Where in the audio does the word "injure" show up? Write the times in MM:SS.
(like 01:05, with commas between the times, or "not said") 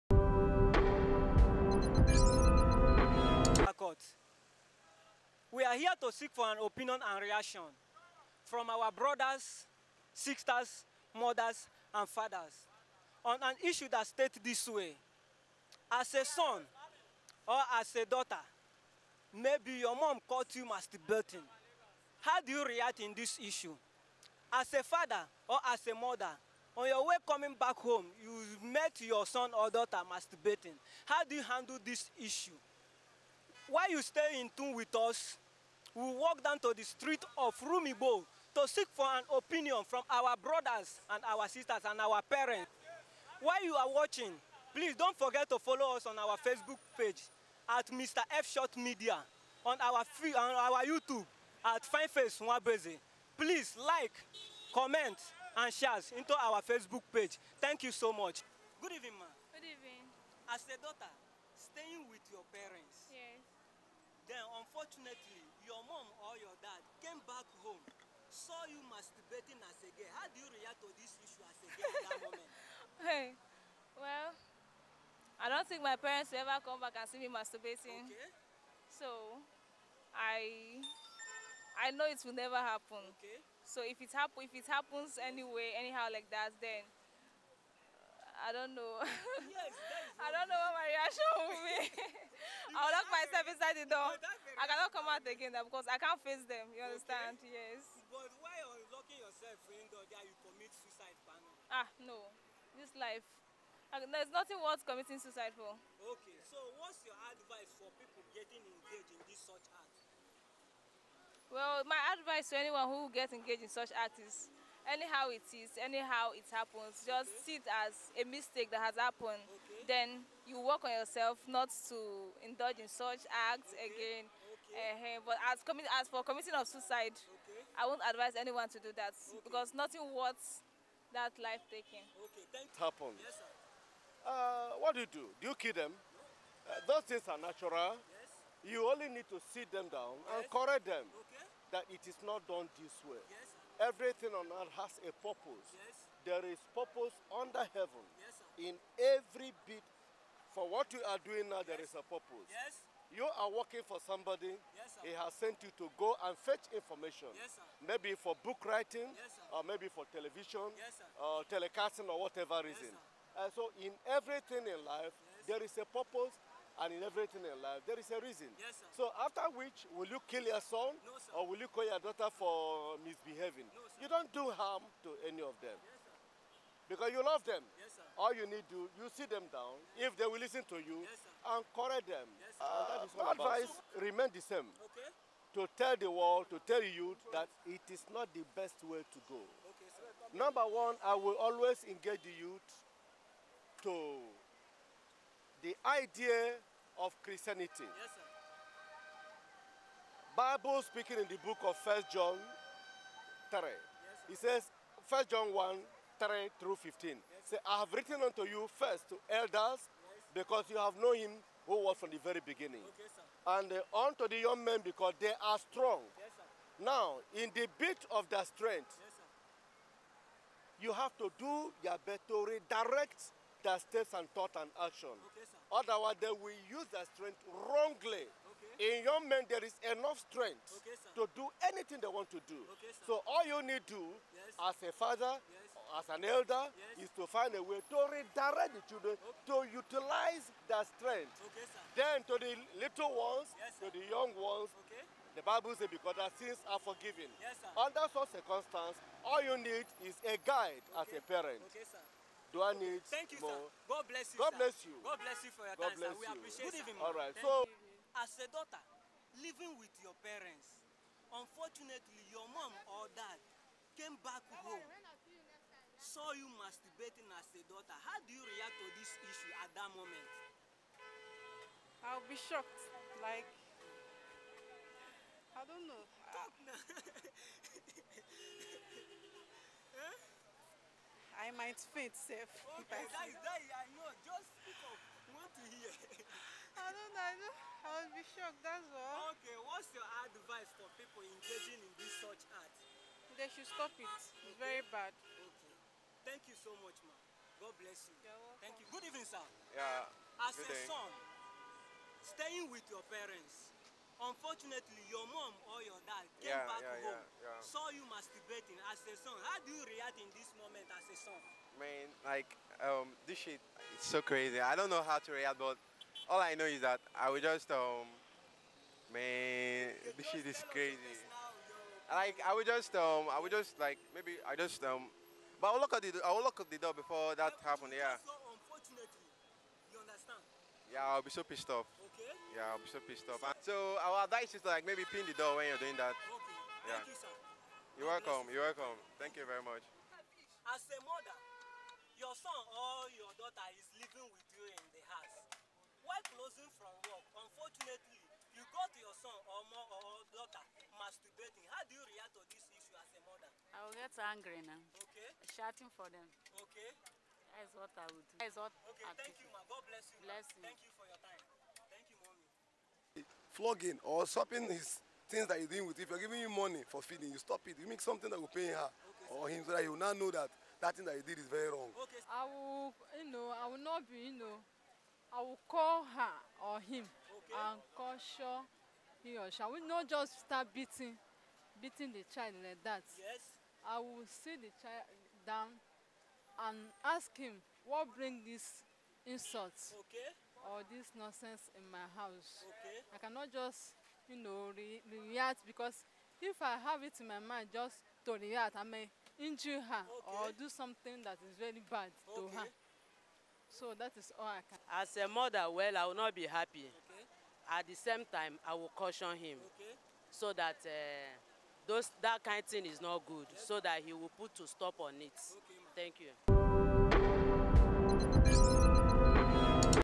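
06:39.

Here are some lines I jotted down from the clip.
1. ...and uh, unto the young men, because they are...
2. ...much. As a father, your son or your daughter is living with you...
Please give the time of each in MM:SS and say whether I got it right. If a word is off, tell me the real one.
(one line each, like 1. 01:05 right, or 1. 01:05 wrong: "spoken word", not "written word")
1. 03:33 right
2. 05:39 wrong: "mother", not "father".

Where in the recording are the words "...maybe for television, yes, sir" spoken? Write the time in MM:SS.
02:39.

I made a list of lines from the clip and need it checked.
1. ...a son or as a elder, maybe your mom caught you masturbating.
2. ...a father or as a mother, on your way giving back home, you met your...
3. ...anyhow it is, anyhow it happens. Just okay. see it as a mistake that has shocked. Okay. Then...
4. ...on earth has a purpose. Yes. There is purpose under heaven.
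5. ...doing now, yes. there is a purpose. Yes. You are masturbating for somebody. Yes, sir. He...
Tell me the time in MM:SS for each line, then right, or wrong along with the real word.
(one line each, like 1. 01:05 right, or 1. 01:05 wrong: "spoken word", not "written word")
1. 00:16 wrong: "daughter", not "elder"
2. 00:24 wrong: "coming", not "giving"
3. 01:54 wrong: "happened", not "shocked"
4. 02:24 right
5. 02:31 wrong: "working", not "masturbating".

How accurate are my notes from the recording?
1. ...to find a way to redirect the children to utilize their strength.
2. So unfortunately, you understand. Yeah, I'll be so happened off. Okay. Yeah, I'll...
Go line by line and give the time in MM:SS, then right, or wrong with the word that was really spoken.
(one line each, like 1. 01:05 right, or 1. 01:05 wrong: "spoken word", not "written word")
1. 03:57 right
2. 05:28 wrong: "pissed", not "happened".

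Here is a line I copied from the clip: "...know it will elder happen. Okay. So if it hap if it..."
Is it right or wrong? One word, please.
wrong.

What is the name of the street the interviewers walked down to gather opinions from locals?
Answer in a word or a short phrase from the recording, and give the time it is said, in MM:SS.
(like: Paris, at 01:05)
Rumibo, at 00:37.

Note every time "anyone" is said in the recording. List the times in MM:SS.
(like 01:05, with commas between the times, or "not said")
01:52, 02:08.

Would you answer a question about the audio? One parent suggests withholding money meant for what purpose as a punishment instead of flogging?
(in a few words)
Feeding.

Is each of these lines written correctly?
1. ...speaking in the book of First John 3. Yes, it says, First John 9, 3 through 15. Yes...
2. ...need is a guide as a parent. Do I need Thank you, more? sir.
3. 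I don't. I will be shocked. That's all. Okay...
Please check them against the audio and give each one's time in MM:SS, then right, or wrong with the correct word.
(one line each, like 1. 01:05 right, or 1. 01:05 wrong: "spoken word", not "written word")
1. 03:20 wrong: "1", not "9"
2. 04:09 right
3. 04:47 right.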